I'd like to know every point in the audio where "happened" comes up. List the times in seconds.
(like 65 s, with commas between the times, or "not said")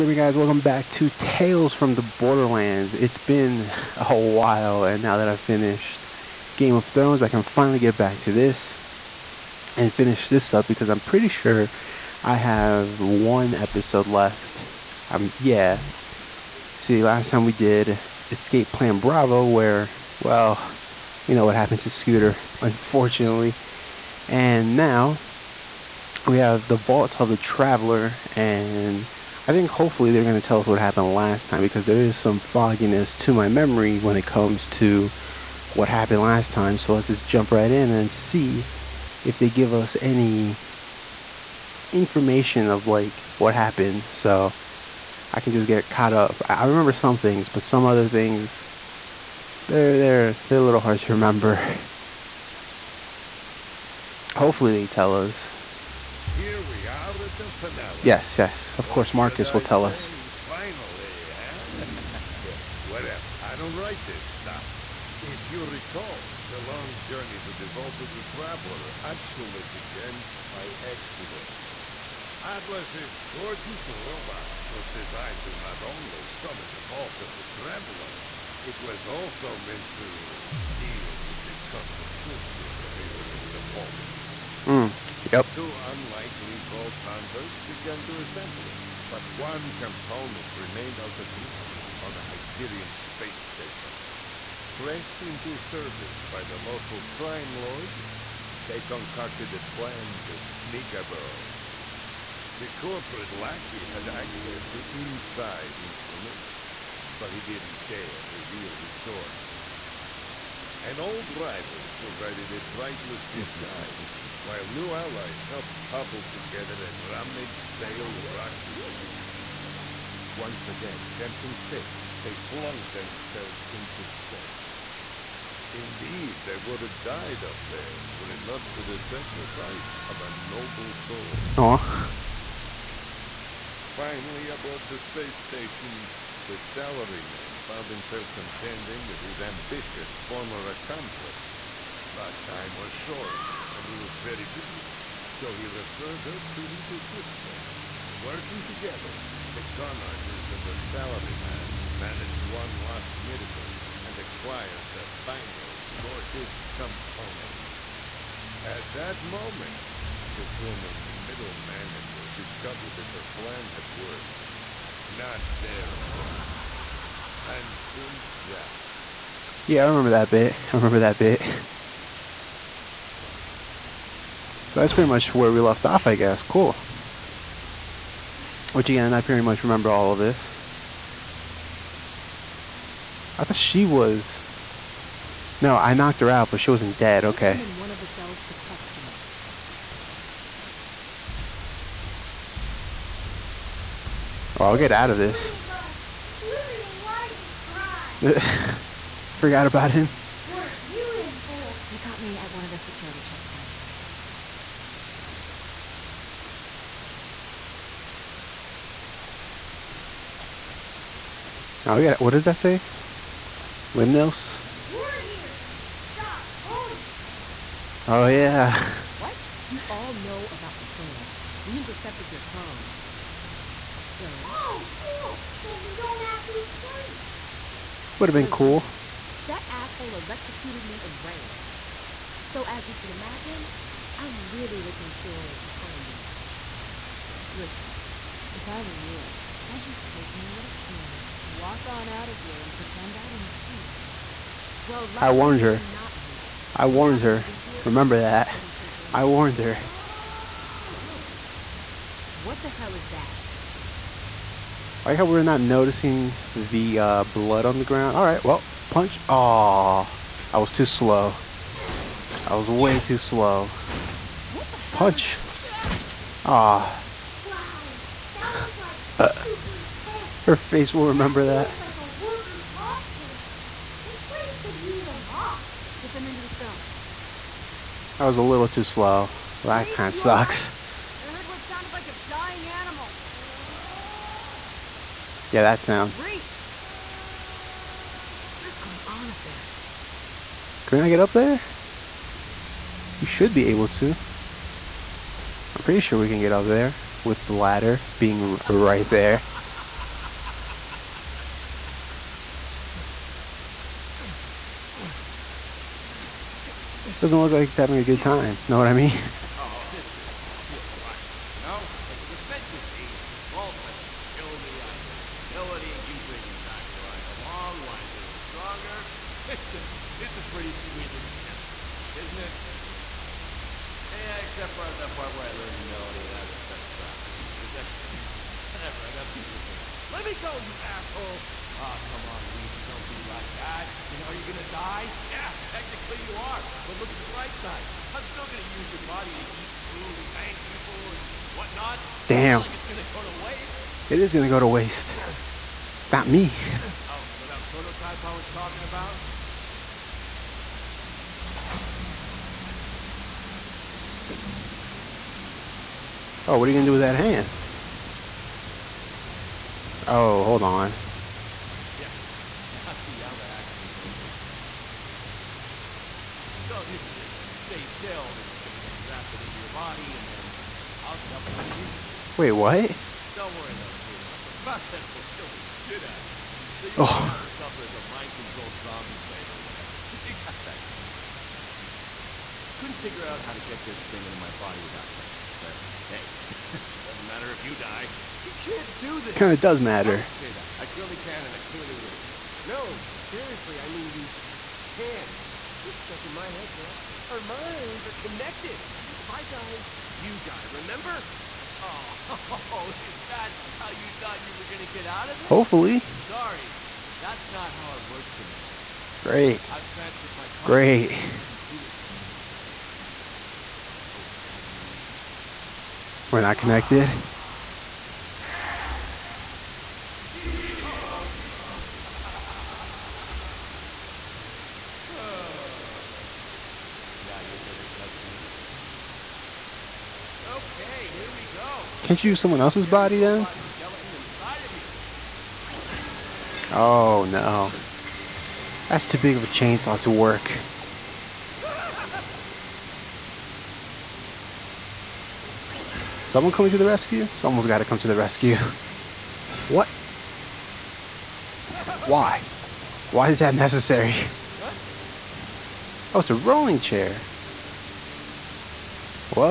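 21 s, 30 s, 35 s, 43 s.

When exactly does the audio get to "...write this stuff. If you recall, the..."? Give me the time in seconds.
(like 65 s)
63 s.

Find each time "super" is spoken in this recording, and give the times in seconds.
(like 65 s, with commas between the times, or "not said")
269 s.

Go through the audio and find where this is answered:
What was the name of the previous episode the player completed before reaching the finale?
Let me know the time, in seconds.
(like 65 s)
18 s.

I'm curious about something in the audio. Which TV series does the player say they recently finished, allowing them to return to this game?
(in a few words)
Game of Thrones.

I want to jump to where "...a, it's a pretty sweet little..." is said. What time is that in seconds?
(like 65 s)
319 s.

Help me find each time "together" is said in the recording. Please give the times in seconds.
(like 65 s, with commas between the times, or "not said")
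116 s, 148 s.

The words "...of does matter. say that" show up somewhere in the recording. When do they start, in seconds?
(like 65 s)
389 s.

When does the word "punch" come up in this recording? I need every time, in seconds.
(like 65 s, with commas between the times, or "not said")
258 s, 264 s.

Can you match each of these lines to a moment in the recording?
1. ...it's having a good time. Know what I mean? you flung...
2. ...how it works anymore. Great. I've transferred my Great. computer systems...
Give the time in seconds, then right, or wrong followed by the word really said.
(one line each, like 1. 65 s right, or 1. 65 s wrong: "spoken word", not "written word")
1. 307 s wrong: "bring", not "flung"
2. 407 s right.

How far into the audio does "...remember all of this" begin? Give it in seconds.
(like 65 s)
179 s.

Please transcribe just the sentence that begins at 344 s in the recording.
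It is gonna go to waste.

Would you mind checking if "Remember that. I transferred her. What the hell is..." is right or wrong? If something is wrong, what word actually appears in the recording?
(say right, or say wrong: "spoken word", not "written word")
wrong: "warned", not "transferred".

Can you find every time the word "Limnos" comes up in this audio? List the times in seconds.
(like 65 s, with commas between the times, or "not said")
213 s.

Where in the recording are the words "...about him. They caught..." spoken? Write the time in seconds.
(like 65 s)
199 s.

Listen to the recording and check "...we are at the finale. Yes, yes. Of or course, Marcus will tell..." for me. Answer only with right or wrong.
right.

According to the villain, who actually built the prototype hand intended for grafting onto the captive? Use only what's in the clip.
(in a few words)
Nakayama.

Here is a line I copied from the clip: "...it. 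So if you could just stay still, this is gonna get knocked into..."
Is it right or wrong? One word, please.
wrong.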